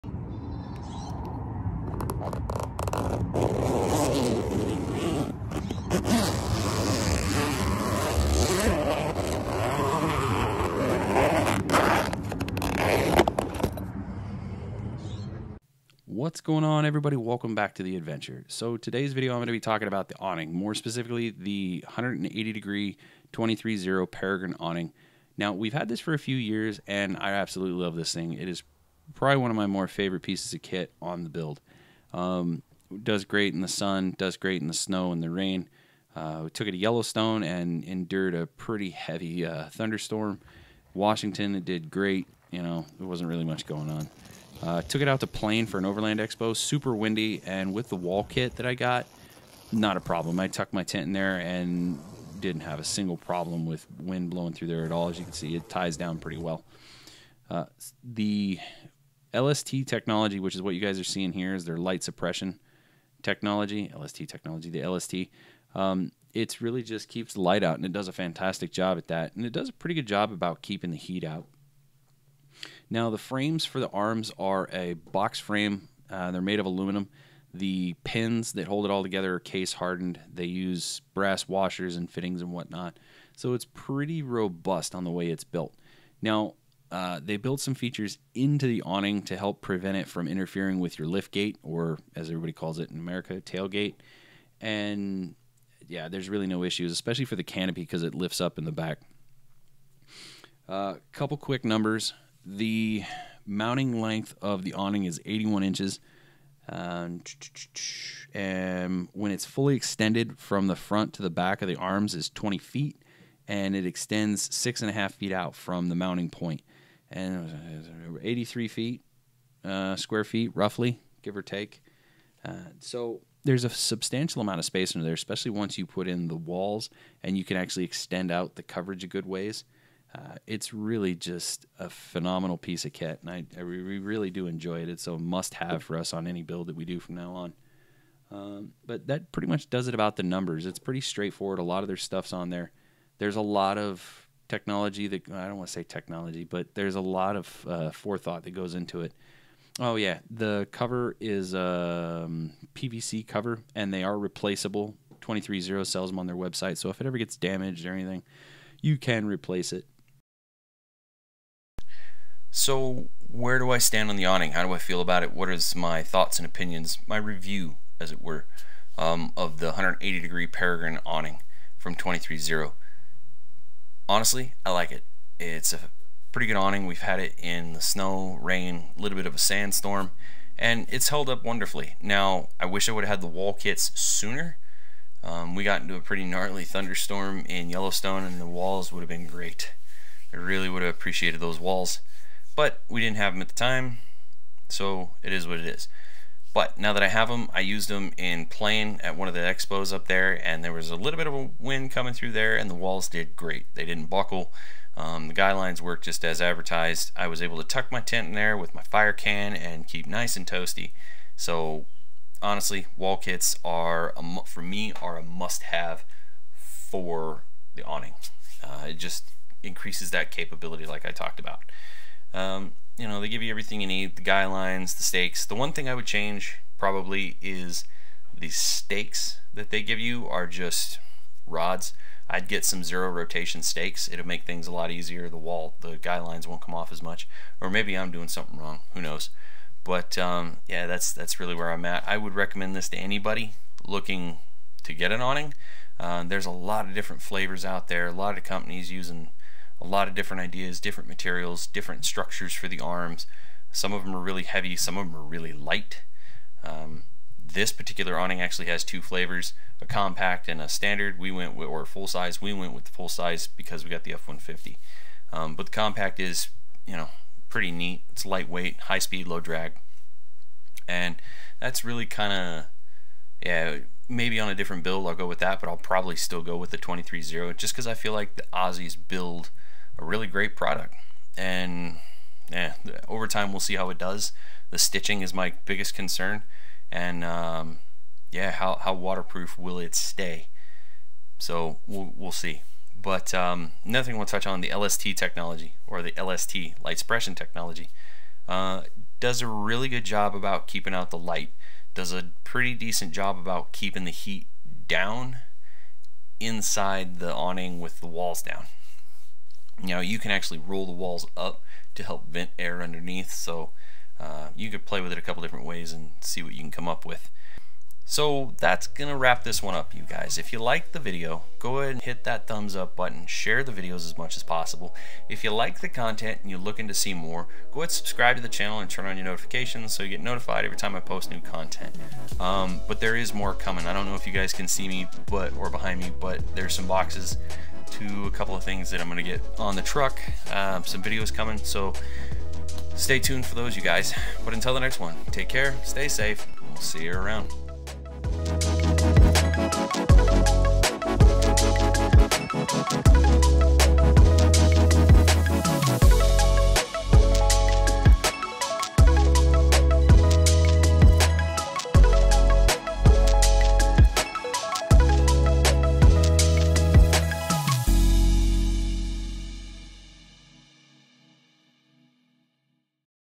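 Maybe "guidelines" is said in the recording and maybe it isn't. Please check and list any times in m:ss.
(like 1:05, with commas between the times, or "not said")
3:25, 3:44, 3:55.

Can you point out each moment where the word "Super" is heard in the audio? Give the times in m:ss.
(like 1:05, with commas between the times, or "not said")
0:46.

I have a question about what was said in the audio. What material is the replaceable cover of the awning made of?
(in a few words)
PVC.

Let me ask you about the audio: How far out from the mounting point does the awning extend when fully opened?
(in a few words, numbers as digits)
6.5 feet.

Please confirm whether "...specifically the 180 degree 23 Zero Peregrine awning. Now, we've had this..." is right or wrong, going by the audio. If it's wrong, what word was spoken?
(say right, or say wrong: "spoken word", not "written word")
right.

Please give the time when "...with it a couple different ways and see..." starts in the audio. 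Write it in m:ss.
5:15.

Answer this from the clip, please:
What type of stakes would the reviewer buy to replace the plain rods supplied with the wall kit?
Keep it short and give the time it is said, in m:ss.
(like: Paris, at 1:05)
Zero rotation stakes, at 3:52.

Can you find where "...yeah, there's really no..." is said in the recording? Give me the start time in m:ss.
1:35.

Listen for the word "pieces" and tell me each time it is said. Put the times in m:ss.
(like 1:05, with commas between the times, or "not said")
0:30, 2:12.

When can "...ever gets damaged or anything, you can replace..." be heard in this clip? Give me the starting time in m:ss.
2:37.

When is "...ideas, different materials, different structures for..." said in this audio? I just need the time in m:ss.
4:10.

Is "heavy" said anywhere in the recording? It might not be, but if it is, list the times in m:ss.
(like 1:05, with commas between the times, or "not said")
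0:38, 4:14.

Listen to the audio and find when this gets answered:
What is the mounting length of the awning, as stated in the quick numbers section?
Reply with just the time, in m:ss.
1:45.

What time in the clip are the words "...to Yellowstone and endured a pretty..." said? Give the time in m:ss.
0:36.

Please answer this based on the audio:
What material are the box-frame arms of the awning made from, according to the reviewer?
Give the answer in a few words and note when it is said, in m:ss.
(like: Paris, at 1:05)
Aluminum, at 1:16.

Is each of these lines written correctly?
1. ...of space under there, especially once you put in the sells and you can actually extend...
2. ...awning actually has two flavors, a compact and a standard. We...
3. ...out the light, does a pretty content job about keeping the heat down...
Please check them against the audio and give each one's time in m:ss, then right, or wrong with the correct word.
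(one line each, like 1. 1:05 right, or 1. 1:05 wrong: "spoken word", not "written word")
1. 2:04 wrong: "walls", not "sells"
2. 4:18 right
3. 5:00 wrong: "decent", not "content".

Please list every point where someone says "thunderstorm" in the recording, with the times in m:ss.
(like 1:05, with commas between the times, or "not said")
0:39, 3:06.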